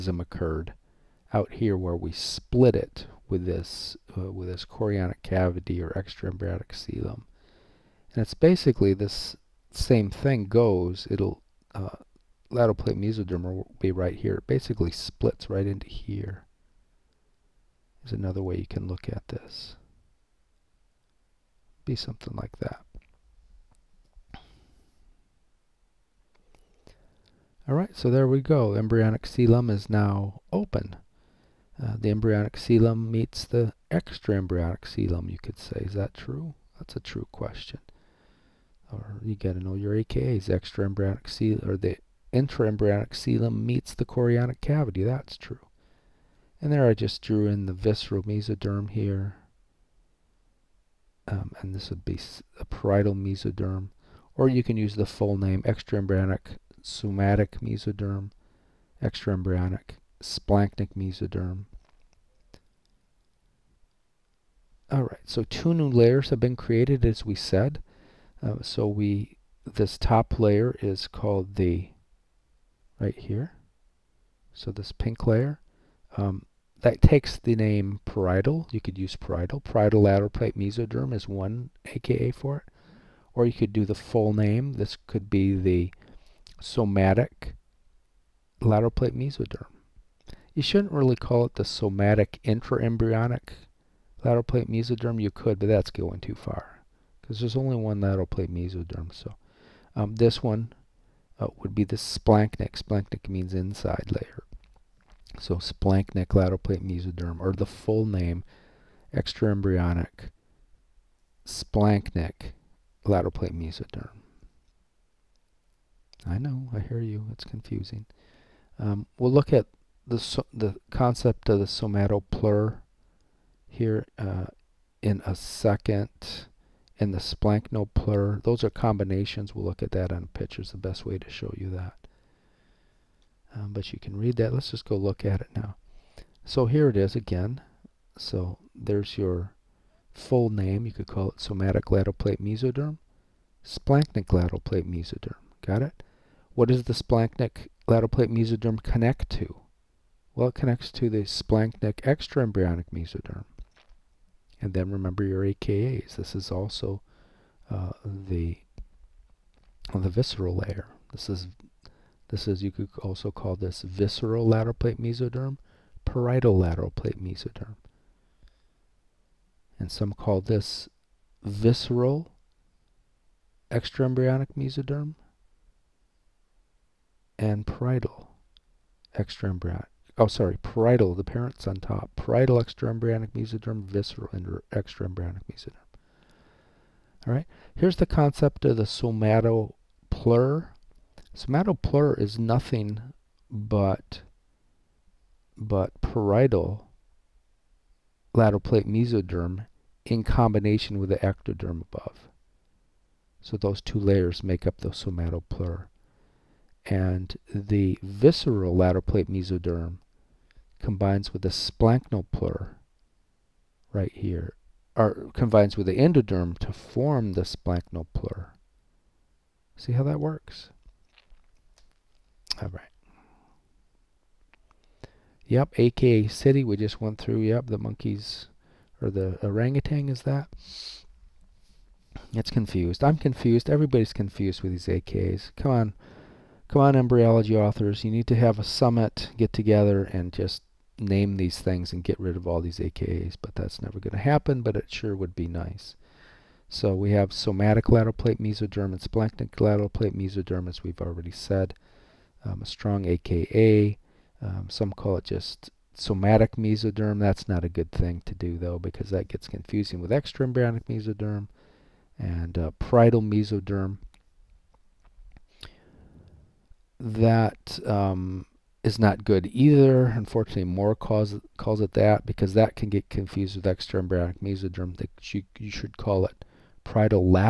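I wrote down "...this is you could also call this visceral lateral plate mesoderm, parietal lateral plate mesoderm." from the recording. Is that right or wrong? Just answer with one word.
right.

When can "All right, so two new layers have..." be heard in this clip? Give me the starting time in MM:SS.
01:04.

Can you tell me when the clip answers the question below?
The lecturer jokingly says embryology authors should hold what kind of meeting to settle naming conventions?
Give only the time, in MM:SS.
03:58.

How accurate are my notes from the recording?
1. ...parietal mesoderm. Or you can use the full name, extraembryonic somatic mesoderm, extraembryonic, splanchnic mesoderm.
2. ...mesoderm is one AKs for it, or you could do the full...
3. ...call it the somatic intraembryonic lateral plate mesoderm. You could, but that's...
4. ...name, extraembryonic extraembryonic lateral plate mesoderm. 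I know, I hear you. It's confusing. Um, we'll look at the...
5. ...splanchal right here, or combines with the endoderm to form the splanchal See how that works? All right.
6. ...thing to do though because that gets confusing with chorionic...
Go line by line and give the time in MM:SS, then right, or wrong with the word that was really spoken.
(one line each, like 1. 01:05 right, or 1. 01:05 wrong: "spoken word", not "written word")
1. 00:52 right
2. 01:20 wrong: "AKA", not "AKs"
3. 01:31 right
4. 01:48 wrong: "splanchnic", not "extraembryonic"
5. 03:31 right
6. 04:17 wrong: "extraembryonic", not "chorionic".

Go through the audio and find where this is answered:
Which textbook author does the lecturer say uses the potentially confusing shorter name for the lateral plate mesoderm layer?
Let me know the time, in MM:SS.
04:30.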